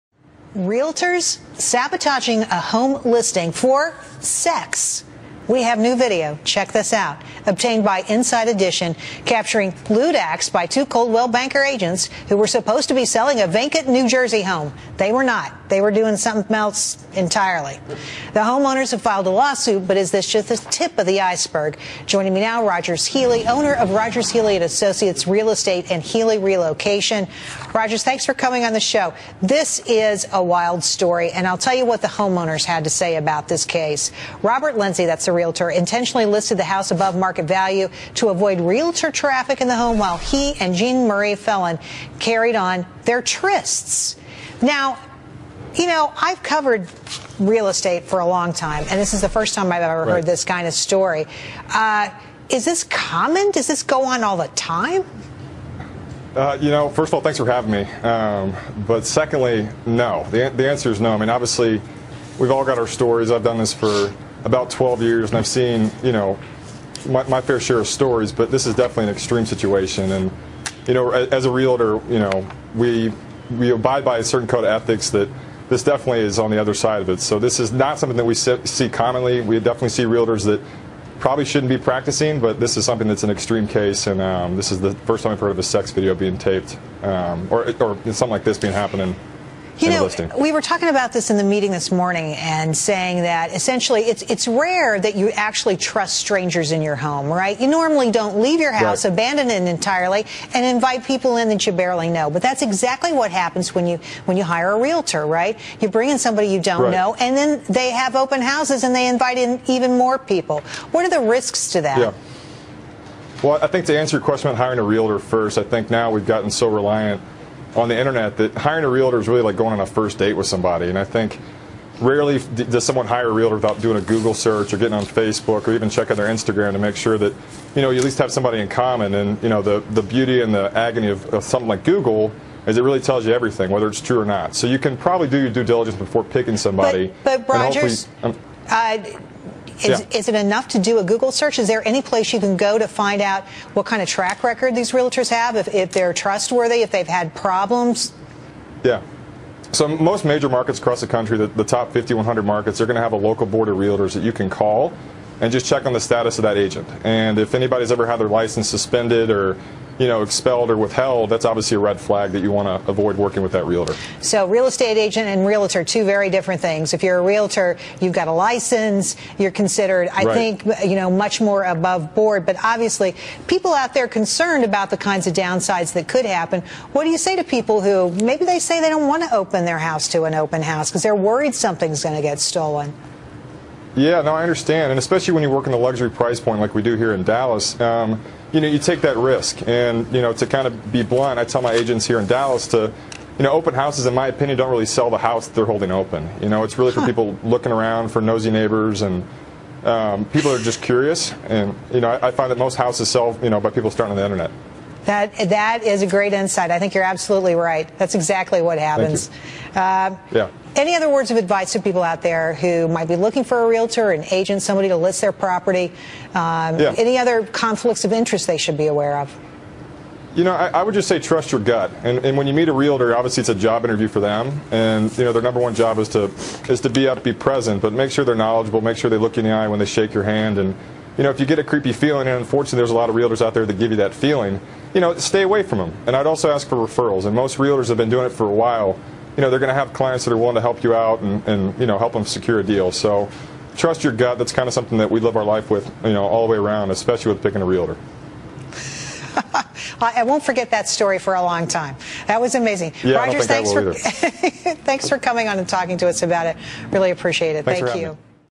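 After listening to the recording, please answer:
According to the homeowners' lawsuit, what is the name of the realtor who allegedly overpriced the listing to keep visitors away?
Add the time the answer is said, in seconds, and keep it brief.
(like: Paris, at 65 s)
Robert Lindsay, at 34 s.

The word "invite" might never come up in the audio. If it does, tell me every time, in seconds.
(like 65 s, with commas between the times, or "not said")
100 s, 109 s.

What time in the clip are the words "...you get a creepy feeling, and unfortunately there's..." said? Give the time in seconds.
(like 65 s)
231 s.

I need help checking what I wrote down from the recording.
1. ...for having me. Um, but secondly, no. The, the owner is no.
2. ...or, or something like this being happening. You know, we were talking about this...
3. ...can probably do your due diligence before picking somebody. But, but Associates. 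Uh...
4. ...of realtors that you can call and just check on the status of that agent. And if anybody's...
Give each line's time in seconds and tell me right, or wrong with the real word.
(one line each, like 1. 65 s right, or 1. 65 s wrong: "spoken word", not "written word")
1. 57 s wrong: "answer", not "owner"
2. 87 s right
3. 134 s wrong: "Rogers", not "Associates"
4. 153 s right.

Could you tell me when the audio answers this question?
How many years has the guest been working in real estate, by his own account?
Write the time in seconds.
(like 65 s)
64 s.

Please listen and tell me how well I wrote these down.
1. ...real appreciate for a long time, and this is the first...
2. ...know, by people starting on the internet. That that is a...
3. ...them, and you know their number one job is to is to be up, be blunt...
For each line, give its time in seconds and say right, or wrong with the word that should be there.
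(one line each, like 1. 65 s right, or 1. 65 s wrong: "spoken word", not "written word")
1. 47 s wrong: "estate", not "appreciate"
2. 203 s right
3. 224 s wrong: "present", not "blunt".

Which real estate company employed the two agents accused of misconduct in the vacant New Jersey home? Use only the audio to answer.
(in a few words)
Coldwell Banker.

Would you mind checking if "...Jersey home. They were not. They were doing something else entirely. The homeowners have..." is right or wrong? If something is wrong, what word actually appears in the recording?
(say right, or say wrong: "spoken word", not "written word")
right.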